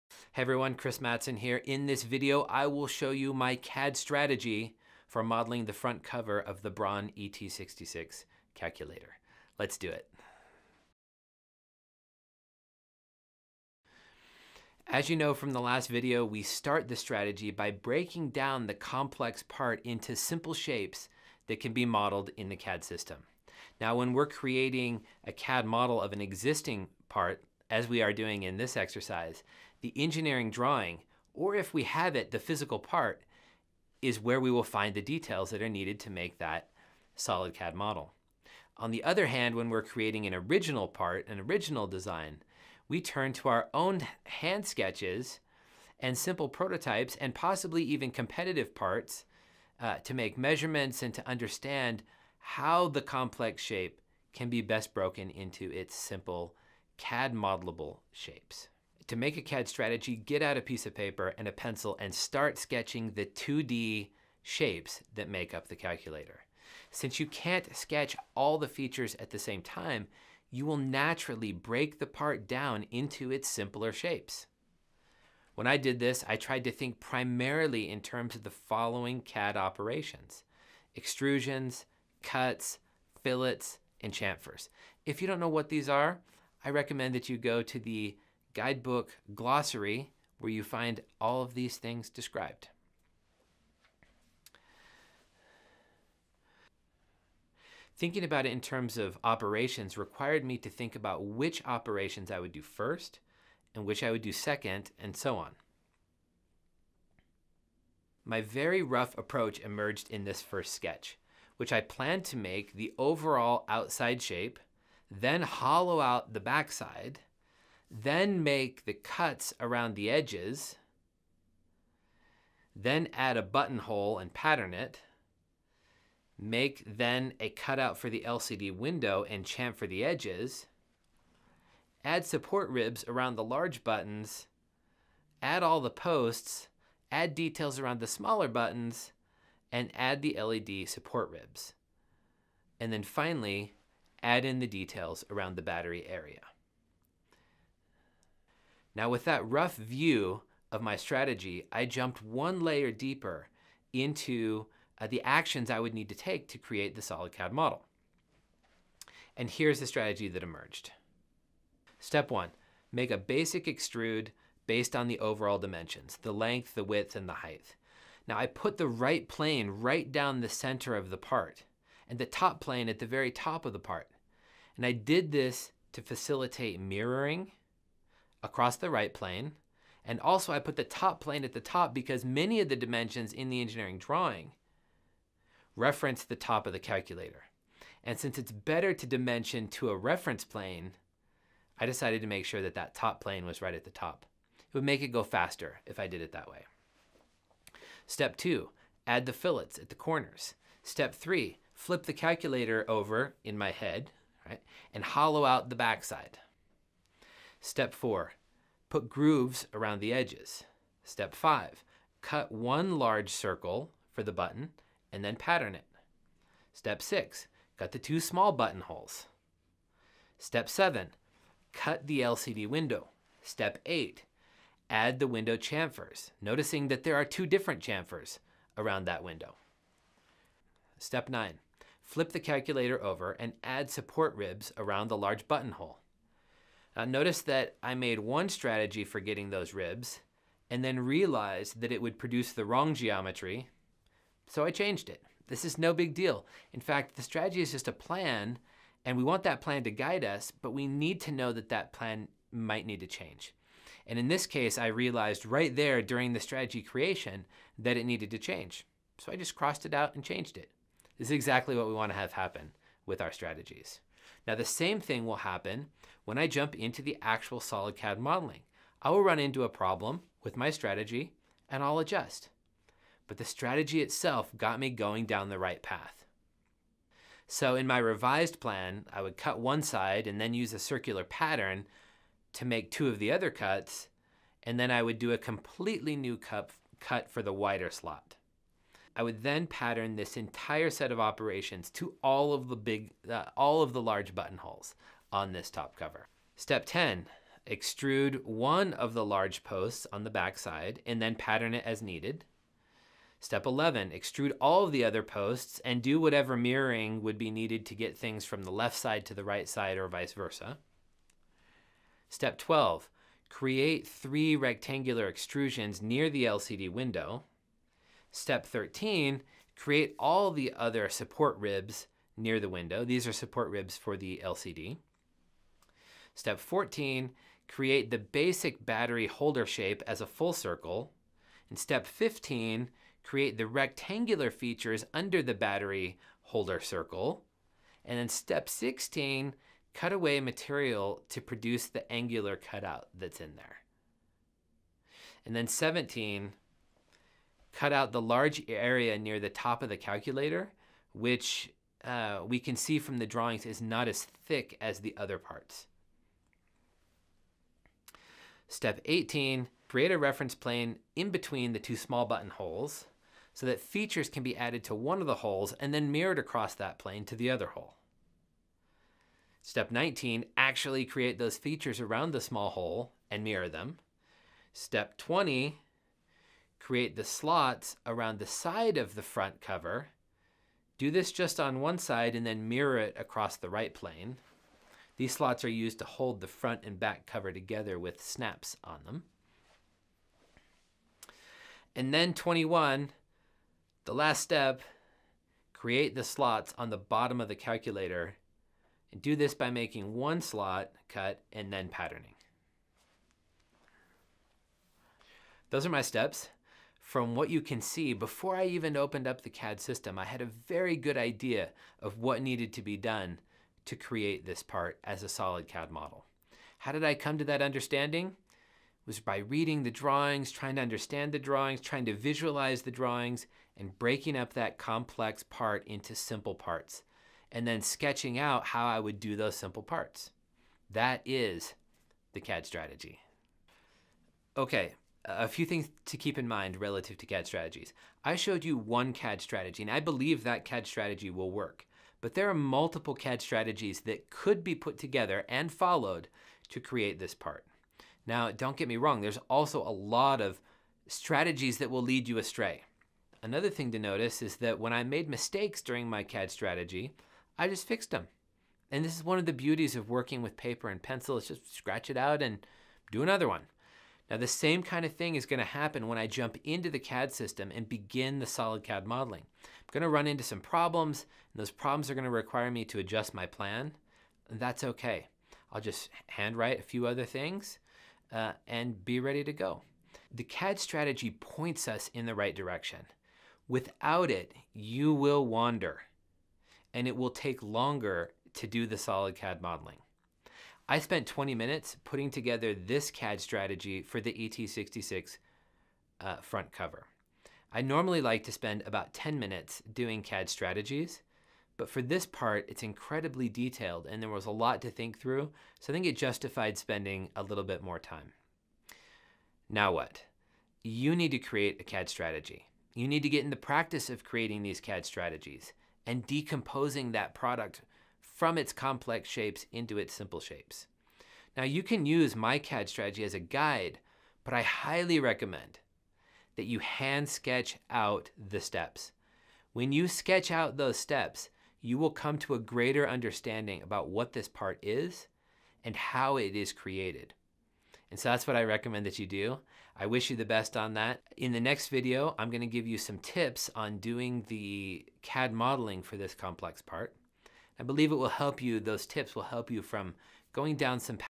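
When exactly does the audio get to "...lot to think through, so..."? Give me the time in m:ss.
8:24.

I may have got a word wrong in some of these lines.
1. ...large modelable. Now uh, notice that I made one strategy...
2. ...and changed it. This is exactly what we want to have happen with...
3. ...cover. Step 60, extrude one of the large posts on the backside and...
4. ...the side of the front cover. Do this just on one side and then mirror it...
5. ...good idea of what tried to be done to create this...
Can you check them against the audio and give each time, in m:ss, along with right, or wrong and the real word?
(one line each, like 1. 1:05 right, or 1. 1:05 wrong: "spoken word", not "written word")
1. 3:55 wrong: "buttonhole", not "modelable"
2. 4:20 right
3. 4:55 wrong: "10", not "60"
4. 6:18 right
5. 6:50 wrong: "needed", not "tried".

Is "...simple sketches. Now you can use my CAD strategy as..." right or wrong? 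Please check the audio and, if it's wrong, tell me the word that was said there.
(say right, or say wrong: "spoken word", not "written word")
wrong: "shapes", not "sketches".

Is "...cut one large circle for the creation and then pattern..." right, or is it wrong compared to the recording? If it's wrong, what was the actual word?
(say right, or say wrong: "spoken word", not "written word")
wrong: "button", not "creation".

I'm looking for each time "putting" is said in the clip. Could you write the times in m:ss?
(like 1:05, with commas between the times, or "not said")
8:12.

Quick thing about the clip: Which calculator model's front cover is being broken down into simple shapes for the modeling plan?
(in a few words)
Braun ET66.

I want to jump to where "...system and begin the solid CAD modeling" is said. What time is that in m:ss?
7:47.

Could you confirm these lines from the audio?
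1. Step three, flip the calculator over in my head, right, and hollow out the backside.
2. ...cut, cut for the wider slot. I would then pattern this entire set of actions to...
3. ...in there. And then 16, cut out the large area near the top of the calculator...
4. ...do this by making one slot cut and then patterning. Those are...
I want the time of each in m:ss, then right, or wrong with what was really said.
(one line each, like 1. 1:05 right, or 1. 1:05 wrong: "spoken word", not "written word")
1. 3:20 right
2. 4:46 wrong: "operations", not "actions"
3. 5:43 wrong: "17", not "16"
4. 6:39 right.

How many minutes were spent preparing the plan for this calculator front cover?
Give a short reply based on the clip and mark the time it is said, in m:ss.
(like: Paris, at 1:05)
20, at 8:11.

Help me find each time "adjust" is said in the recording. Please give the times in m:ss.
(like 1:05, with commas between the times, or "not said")
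4:31, 7:52.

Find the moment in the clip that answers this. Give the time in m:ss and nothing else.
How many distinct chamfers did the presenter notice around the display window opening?
3:47.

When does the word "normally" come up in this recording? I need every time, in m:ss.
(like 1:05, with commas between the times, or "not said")
8:17.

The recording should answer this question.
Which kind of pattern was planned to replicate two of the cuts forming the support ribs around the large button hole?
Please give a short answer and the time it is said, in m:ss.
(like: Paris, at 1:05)
circular pattern, at 4:40.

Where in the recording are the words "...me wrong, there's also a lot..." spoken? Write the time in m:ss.
7:28.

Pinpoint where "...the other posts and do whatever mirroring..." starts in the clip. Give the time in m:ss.
5:04.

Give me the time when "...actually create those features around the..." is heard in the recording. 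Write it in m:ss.
6:10.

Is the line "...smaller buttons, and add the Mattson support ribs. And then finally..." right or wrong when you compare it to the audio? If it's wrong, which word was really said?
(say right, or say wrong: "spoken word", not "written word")
wrong: "LED", not "Mattson".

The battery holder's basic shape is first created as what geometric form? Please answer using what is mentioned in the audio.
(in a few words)
full circle.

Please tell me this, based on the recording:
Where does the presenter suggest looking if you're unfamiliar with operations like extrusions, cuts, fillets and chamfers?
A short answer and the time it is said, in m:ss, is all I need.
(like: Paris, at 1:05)
guidebook glossary, at 1:28.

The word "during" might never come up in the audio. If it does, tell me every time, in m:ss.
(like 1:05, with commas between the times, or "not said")
4:16, 7:35.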